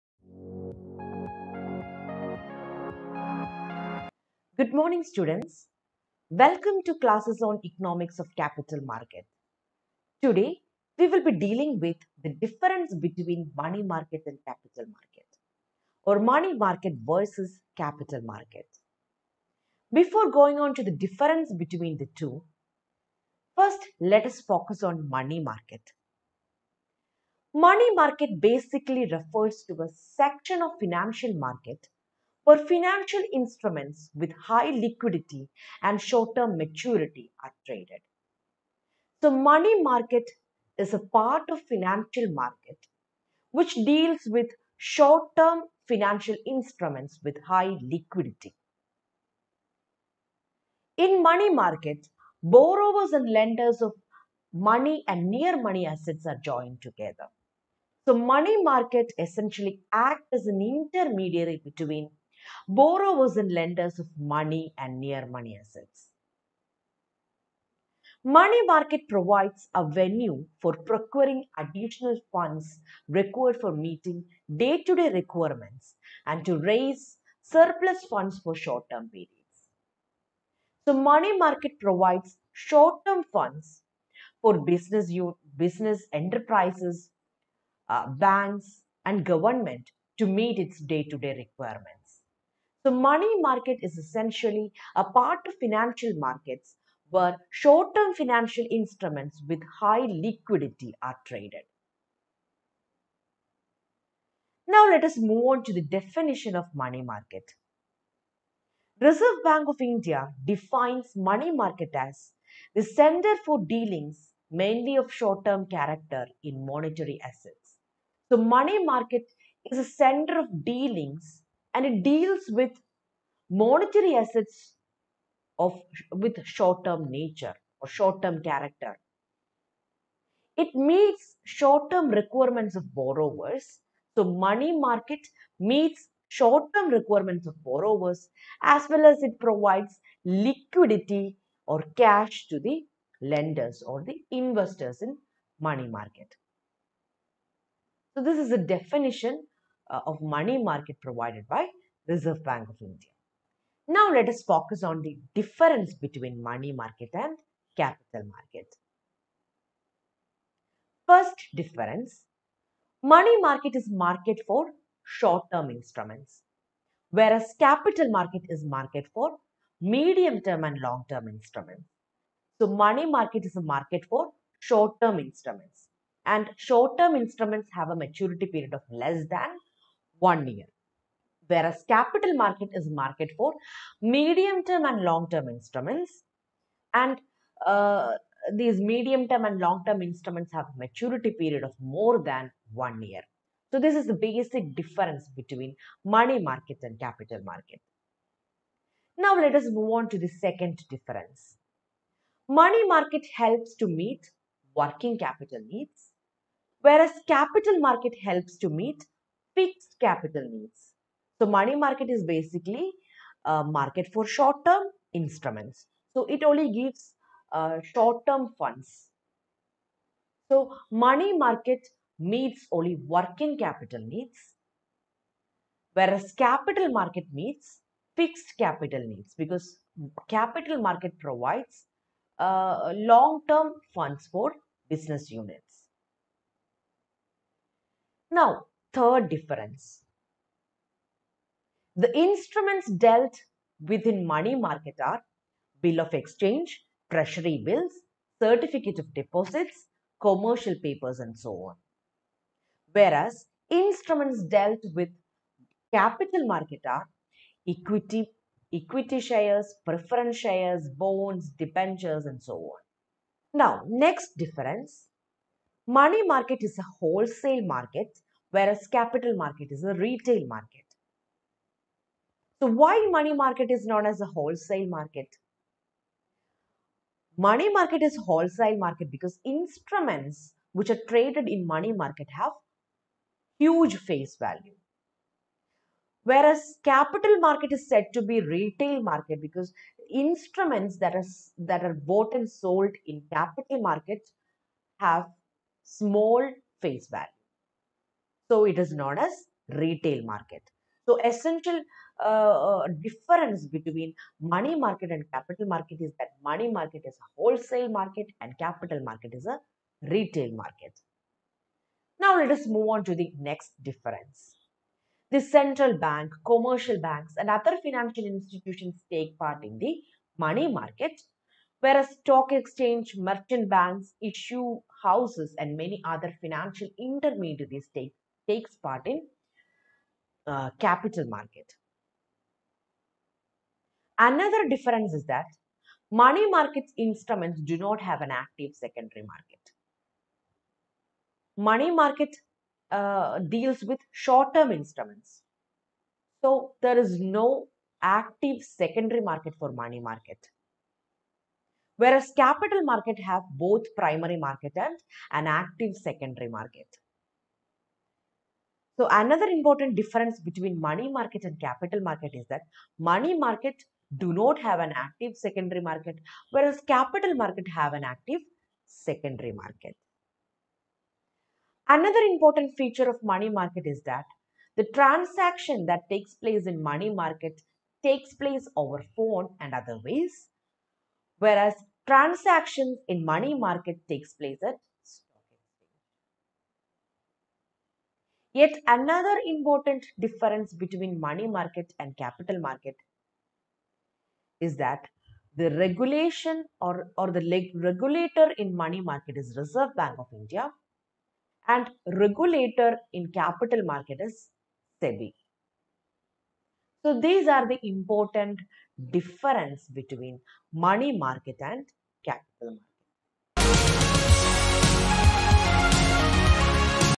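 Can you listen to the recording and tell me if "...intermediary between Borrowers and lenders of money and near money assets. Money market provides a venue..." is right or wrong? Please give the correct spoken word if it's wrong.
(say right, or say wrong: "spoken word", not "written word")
right.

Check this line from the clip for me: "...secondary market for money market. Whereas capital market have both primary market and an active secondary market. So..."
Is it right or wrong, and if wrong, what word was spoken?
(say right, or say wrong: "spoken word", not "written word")
right.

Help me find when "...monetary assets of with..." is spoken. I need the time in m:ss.
2:03.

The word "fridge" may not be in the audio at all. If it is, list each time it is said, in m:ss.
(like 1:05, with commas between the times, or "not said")
not said.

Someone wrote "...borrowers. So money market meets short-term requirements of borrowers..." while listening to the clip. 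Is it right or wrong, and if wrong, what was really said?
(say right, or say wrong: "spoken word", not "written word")
right.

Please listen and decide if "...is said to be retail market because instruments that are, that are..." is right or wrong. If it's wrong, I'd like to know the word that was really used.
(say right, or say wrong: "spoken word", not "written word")
right.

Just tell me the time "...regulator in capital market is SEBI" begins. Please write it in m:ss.
6:42.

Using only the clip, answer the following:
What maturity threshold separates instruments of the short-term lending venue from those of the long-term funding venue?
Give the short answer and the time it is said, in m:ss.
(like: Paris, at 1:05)
1 year, at 2:58.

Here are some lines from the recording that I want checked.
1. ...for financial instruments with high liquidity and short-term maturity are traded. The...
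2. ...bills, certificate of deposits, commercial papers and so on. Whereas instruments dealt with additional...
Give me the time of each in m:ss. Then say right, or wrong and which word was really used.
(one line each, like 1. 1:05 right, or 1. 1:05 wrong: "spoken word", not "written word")
1. 0:32 right
2. 4:07 wrong: "capital", not "additional".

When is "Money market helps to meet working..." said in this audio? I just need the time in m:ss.
3:22.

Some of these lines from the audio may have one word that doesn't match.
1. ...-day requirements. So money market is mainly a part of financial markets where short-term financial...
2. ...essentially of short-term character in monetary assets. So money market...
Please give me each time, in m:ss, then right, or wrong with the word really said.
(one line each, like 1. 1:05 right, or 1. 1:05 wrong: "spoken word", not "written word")
1. 1:31 wrong: "essentially", not "mainly"
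2. 1:54 wrong: "mainly", not "essentially".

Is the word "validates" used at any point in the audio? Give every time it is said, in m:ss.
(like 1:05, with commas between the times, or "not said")
not said.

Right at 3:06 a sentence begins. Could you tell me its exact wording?
And uh, these medium term and long term instruments have maturity period of more than one year.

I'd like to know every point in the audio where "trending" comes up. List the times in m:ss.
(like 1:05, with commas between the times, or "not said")
not said.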